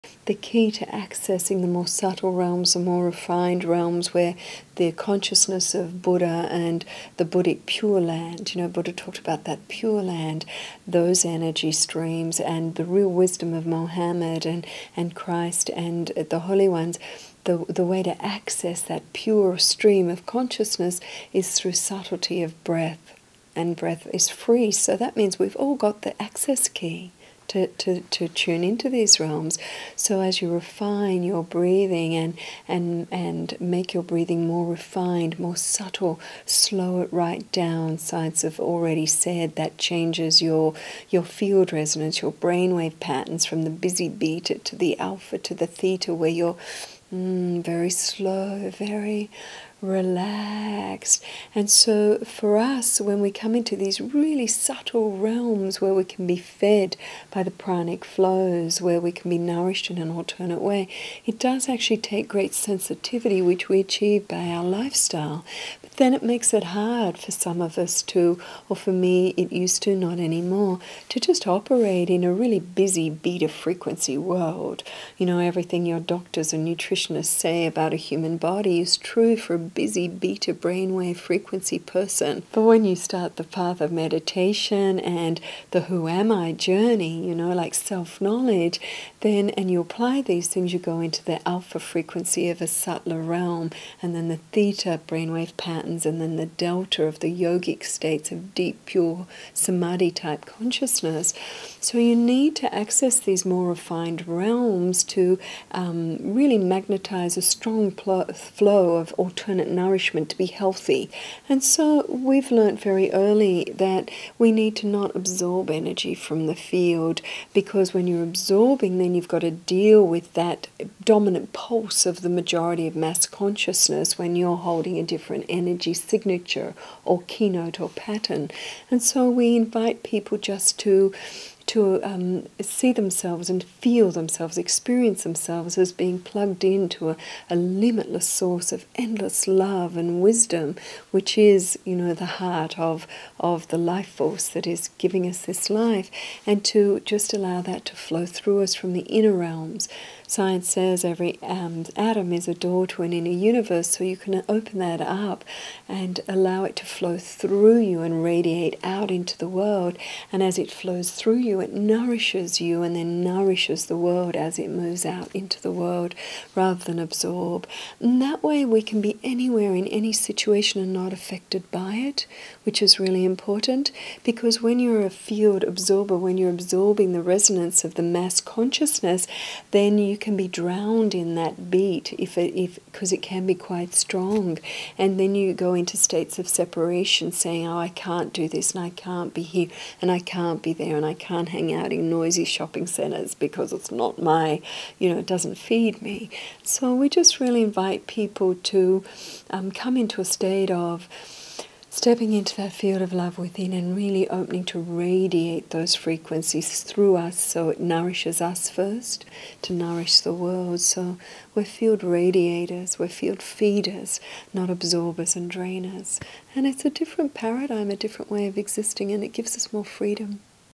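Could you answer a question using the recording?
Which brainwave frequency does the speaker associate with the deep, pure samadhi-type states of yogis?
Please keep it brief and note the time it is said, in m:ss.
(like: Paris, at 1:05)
Delta, at 1:36.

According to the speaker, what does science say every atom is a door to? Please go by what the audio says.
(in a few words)
An inner universe.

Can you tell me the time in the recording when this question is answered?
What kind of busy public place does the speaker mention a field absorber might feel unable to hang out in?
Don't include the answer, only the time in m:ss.
3:12.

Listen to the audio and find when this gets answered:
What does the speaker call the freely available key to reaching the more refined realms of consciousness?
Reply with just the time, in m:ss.
0:21.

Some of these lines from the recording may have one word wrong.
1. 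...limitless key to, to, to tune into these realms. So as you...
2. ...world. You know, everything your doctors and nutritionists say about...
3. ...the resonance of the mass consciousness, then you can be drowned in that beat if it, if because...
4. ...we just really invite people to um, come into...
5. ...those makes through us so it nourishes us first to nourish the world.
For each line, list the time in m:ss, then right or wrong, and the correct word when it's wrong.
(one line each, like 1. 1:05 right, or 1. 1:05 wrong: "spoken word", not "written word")
1. 0:26 wrong: "access", not "limitless"
2. 1:14 right
3. 2:57 right
4. 3:16 right
5. 3:25 wrong: "frequencies", not "makes".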